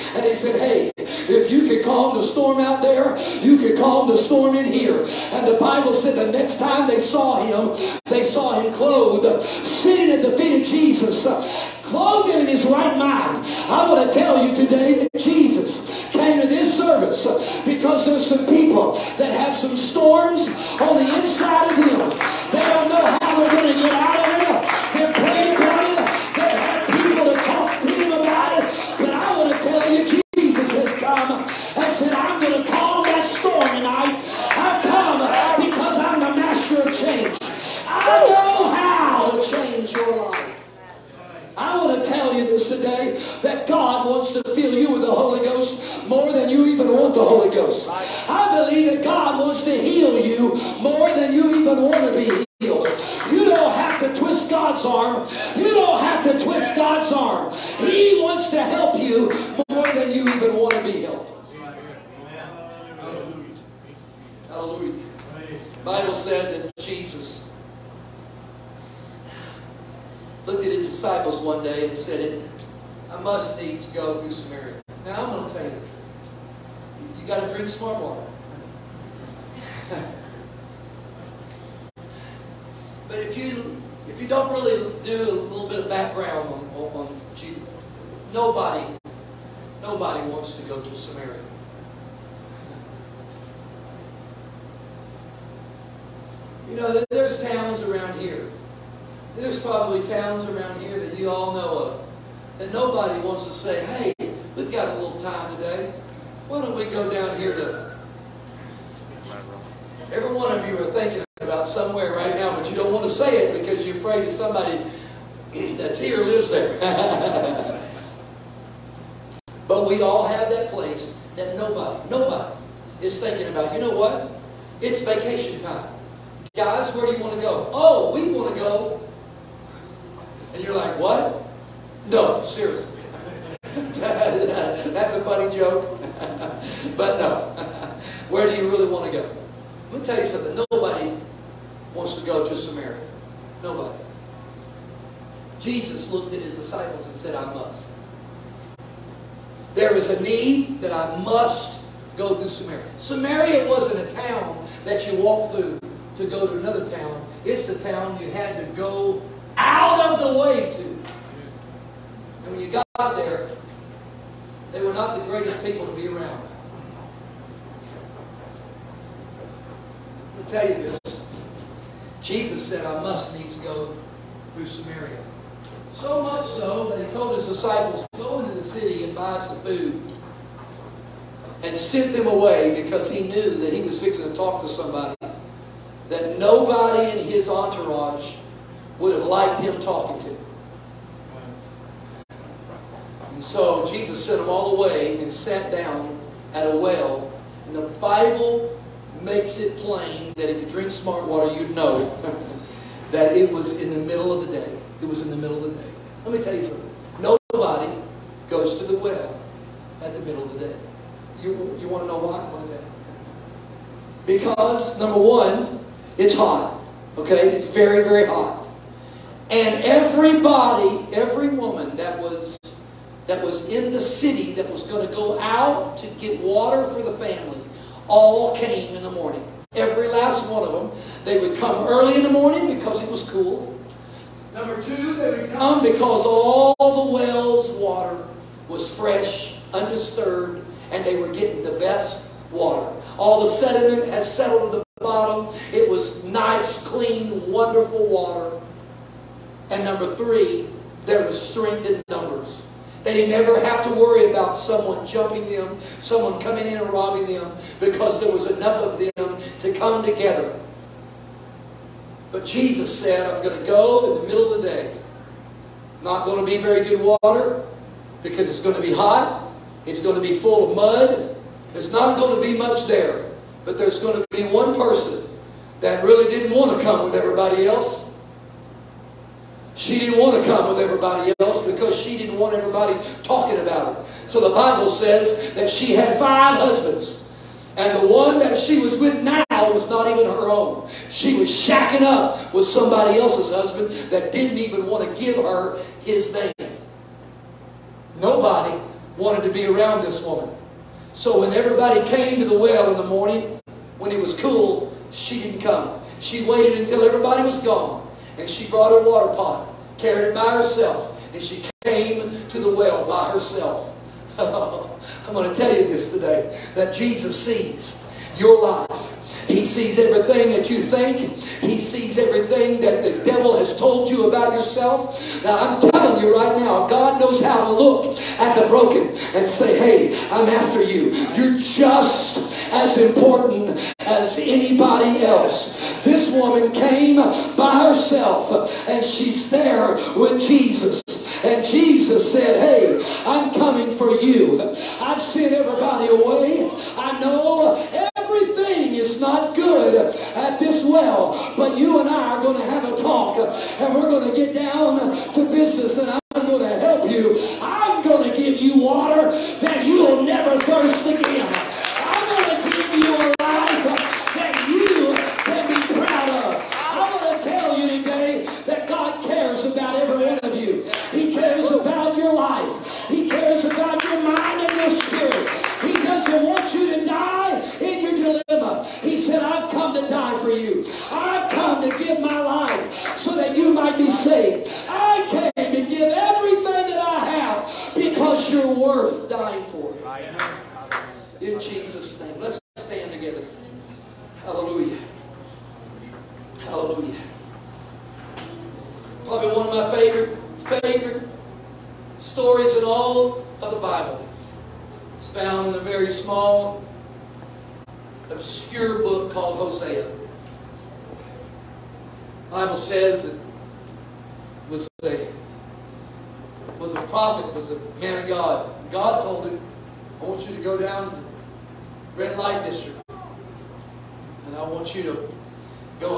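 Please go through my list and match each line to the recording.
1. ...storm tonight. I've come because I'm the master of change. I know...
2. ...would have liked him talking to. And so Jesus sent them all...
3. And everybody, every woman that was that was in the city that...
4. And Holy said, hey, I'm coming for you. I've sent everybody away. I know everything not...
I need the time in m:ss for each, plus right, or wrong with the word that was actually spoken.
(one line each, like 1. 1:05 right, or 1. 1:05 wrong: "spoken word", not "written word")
1. 0:33 right
2. 3:08 right
3. 3:39 right
4. 5:41 wrong: "Jesus", not "Holy".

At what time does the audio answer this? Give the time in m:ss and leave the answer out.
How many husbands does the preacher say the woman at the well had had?
4:46.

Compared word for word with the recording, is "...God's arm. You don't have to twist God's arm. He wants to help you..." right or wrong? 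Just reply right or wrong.
right.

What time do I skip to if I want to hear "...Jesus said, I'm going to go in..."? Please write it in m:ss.
4:22.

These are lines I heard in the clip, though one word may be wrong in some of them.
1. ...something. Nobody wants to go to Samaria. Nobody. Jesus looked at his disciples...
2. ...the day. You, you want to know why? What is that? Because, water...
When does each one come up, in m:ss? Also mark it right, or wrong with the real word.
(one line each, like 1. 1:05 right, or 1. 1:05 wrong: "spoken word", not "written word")
1. 2:20 right
2. 3:30 wrong: "number", not "water".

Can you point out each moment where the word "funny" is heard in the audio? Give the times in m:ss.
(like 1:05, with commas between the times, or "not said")
2:15.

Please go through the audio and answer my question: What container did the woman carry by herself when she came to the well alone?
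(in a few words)
water pot.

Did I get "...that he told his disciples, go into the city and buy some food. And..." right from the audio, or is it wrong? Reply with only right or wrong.
right.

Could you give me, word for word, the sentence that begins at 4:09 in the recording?
And number three, there was strength in numbers.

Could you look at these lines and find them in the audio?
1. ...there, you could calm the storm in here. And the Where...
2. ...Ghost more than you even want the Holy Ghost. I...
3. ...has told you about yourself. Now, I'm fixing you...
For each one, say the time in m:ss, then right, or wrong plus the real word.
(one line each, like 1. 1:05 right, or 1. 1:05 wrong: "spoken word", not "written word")
1. 0:02 wrong: "Bible", not "Where"
2. 0:45 right
3. 5:23 wrong: "telling", not "fixing".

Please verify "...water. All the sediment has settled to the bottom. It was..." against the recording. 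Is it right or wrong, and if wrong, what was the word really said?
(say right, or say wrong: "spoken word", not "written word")
right.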